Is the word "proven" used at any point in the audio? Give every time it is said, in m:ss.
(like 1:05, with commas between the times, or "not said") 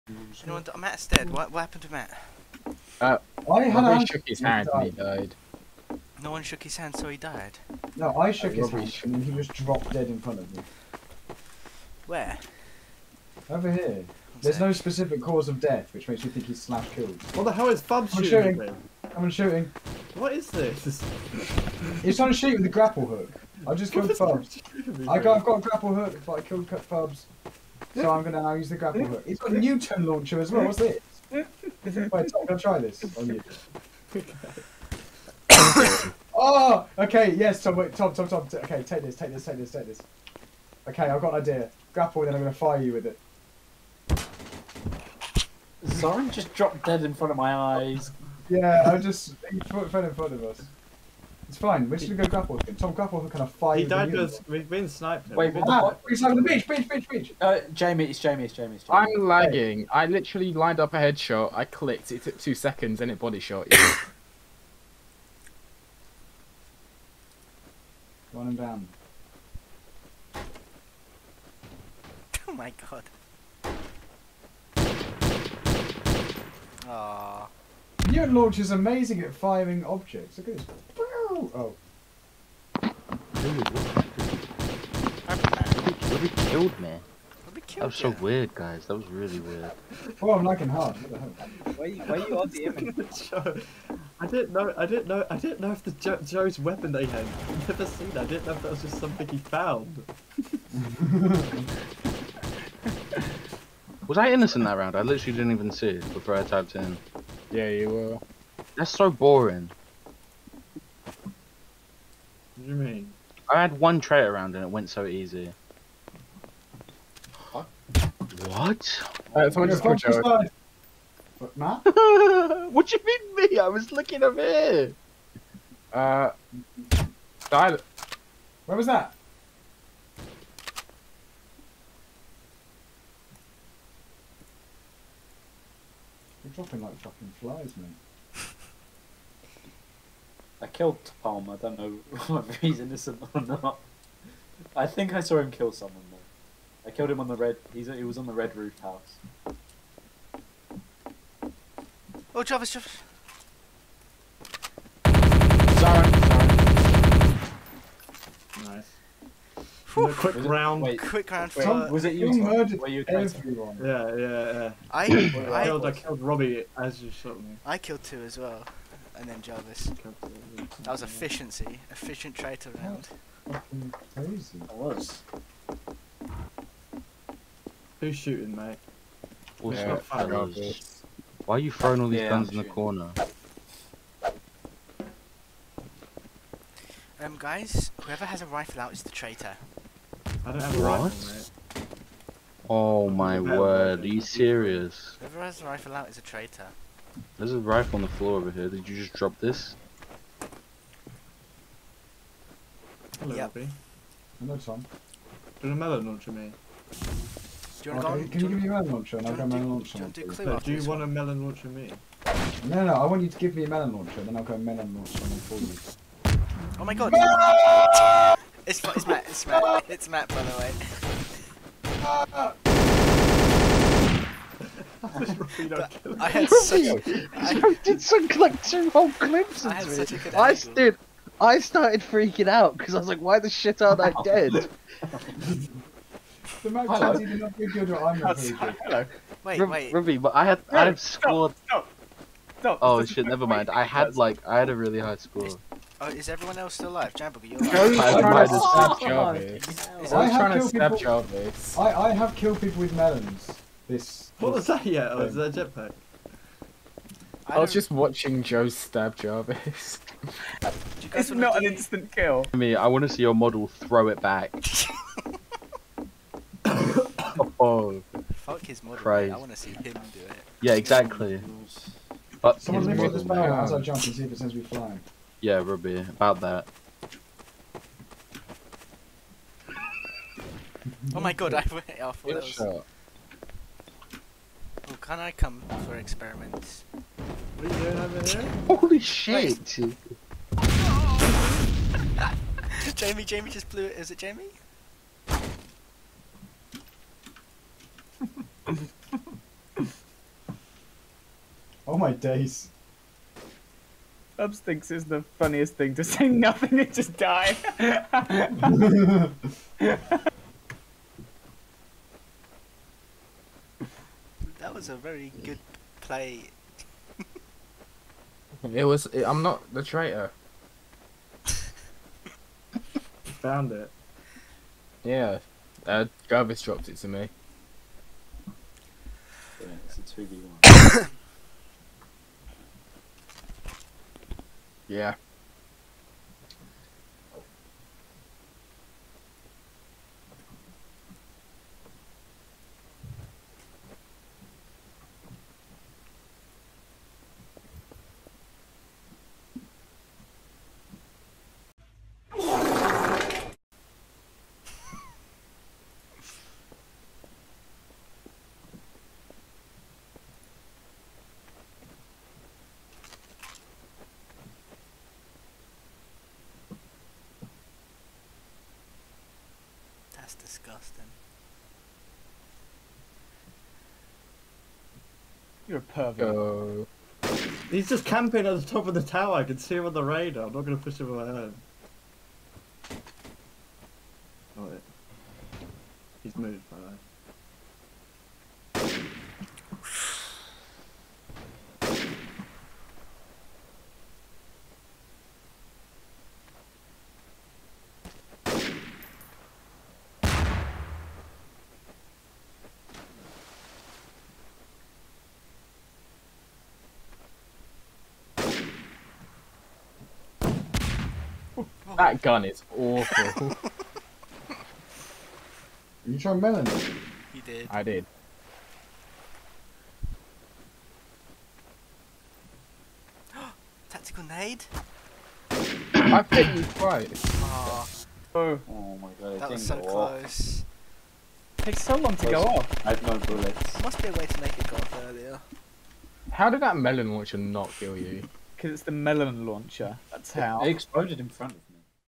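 not said.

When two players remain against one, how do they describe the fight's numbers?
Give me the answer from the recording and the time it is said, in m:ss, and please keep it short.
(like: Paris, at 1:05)
2v1, at 5:31.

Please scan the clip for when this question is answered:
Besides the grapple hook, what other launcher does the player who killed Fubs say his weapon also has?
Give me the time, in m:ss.
0:29.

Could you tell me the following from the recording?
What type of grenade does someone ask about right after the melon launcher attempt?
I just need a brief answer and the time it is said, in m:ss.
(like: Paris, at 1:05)
Tactical nade, at 7:03.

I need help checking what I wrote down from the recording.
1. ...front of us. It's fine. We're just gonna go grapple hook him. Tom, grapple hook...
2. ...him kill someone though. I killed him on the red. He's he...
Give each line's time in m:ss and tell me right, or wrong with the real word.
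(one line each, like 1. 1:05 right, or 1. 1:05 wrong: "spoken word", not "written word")
1. 0:50 right
2. 2:25 right.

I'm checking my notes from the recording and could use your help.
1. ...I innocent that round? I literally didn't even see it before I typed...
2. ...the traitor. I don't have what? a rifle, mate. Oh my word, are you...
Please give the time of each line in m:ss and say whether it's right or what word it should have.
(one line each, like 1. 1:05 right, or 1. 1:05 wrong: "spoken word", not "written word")
1. 1:44 right
2. 3:09 right.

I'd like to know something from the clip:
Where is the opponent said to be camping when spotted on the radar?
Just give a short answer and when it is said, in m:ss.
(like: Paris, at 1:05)
Top of the tower, at 6:18.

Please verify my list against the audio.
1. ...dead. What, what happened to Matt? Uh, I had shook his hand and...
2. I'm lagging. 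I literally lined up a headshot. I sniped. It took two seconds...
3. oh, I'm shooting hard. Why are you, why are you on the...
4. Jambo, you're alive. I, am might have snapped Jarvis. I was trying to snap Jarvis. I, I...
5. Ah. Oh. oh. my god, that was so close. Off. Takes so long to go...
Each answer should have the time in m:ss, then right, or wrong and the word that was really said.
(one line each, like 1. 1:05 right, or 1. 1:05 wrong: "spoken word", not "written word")
1. 0:01 right
2. 0:59 wrong: "clicked", not "sniped"
3. 1:30 wrong: "lagging", not "shooting"
4. 4:07 right
5. 7:07 right.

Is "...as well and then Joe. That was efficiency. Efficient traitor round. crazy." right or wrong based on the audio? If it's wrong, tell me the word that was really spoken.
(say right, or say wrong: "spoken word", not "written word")
wrong: "Jarvis", not "Joe".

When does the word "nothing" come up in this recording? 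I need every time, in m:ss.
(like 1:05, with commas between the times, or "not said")
5:06.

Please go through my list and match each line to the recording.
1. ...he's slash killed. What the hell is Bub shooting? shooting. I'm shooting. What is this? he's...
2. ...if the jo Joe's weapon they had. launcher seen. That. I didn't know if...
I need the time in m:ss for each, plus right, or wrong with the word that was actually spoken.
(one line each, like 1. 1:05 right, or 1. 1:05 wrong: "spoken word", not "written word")
1. 0:16 right
2. 1:35 wrong: "never", not "launcher".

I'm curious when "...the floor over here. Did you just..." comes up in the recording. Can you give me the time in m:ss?
3:18.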